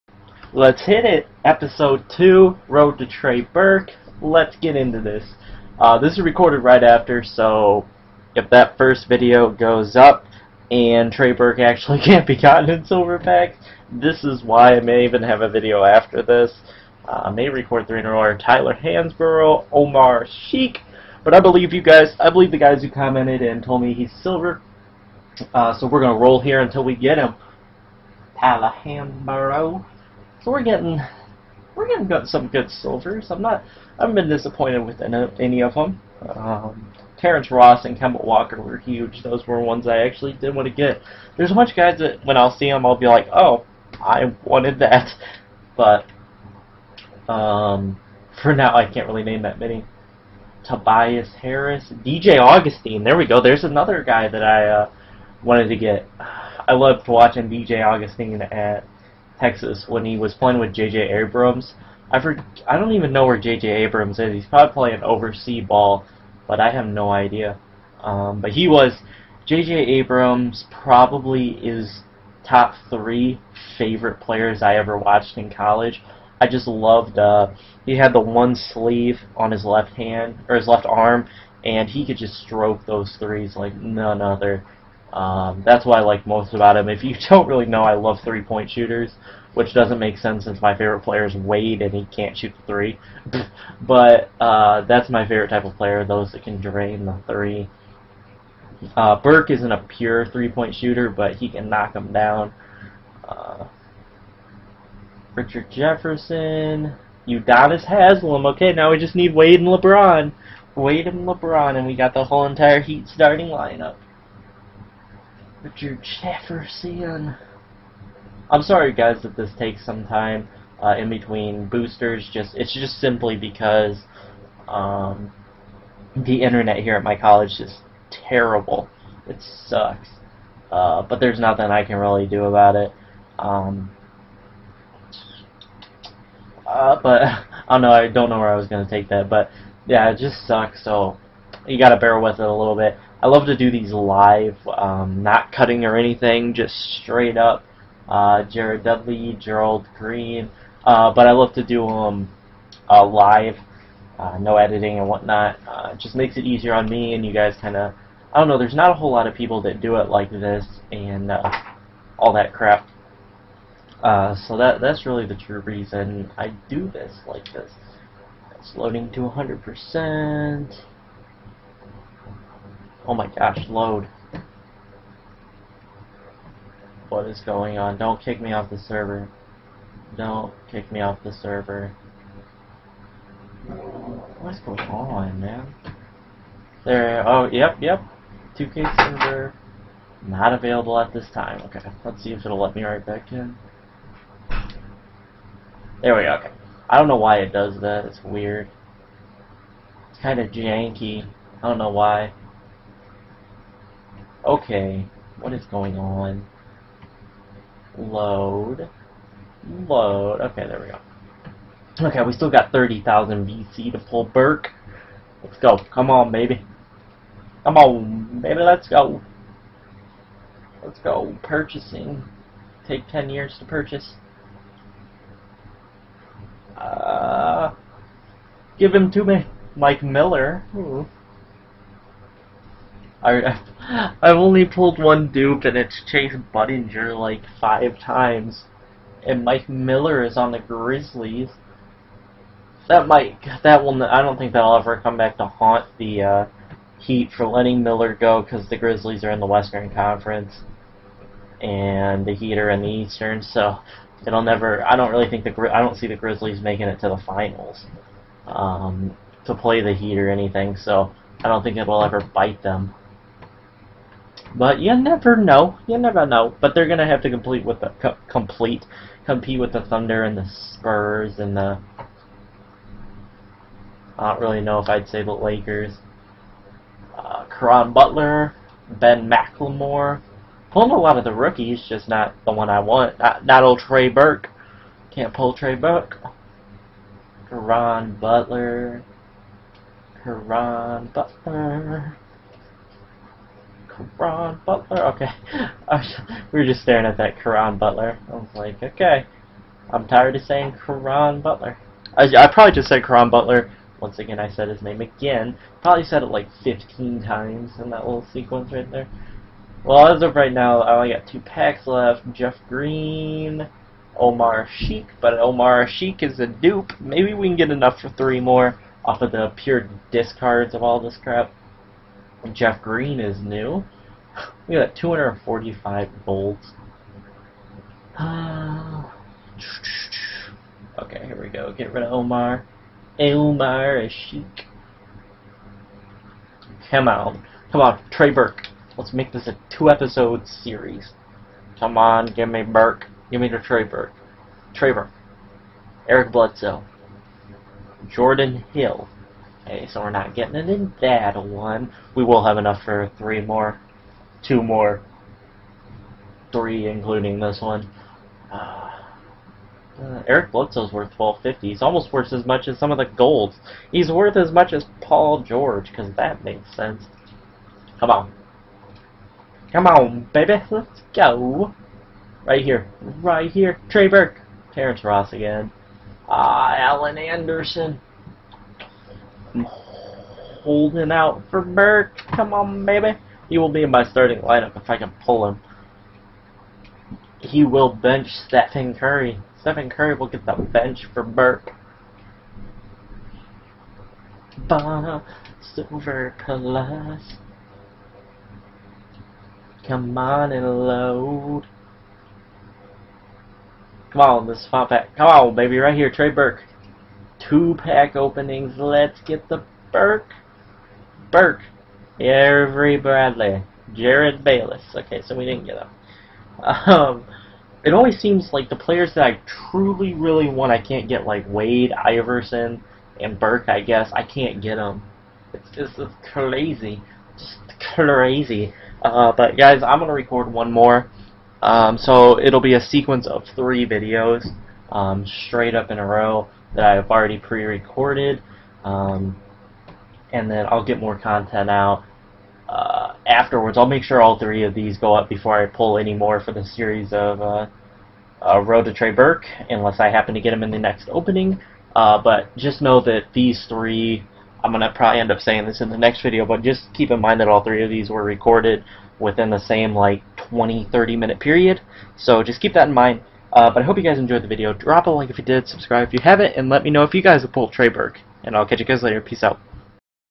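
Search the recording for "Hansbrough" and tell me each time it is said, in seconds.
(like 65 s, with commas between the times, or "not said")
18 s, 28 s.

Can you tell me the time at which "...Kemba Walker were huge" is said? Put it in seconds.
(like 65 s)
37 s.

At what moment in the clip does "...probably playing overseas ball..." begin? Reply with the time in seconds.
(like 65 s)
64 s.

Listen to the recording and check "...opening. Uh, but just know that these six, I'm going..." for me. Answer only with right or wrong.
wrong.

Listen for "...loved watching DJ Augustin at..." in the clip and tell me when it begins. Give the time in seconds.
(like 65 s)
56 s.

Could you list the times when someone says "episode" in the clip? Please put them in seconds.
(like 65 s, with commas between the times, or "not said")
1 s, 339 s.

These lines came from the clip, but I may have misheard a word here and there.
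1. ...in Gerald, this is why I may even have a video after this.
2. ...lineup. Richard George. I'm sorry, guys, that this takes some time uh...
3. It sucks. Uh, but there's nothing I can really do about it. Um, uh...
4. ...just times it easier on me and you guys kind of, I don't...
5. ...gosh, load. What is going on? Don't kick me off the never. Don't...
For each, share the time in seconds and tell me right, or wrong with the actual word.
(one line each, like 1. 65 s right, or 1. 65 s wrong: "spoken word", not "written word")
1. 12 s wrong: "Silverback", not "Gerald"
2. 113 s wrong: "Jefferson", not "George"
3. 129 s right
4. 155 s wrong: "makes", not "times"
5. 173 s wrong: "server", not "never".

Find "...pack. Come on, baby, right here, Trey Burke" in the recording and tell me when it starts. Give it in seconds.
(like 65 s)
404 s.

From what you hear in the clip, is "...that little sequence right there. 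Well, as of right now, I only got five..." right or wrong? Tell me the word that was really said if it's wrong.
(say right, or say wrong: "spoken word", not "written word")
wrong: "two", not "five".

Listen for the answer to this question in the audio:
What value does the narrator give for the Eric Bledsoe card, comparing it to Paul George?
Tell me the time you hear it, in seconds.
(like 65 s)
361 s.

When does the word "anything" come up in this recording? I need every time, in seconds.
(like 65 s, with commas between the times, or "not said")
145 s, 260 s.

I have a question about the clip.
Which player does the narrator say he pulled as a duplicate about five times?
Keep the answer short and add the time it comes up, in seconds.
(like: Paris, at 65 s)
Chase Budinger, at 236 s.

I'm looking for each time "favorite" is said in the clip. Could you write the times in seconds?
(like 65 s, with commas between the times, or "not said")
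73 s, 90 s, 95 s.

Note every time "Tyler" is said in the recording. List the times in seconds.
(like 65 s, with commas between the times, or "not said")
18 s, 28 s.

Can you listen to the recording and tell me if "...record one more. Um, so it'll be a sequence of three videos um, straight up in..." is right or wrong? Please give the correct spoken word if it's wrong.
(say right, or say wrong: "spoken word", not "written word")
right.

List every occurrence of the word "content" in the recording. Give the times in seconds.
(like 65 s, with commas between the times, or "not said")
441 s.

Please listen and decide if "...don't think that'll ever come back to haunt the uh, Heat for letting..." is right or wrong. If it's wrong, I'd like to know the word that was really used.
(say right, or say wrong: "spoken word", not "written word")
right.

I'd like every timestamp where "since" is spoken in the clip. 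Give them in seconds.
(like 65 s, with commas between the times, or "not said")
90 s.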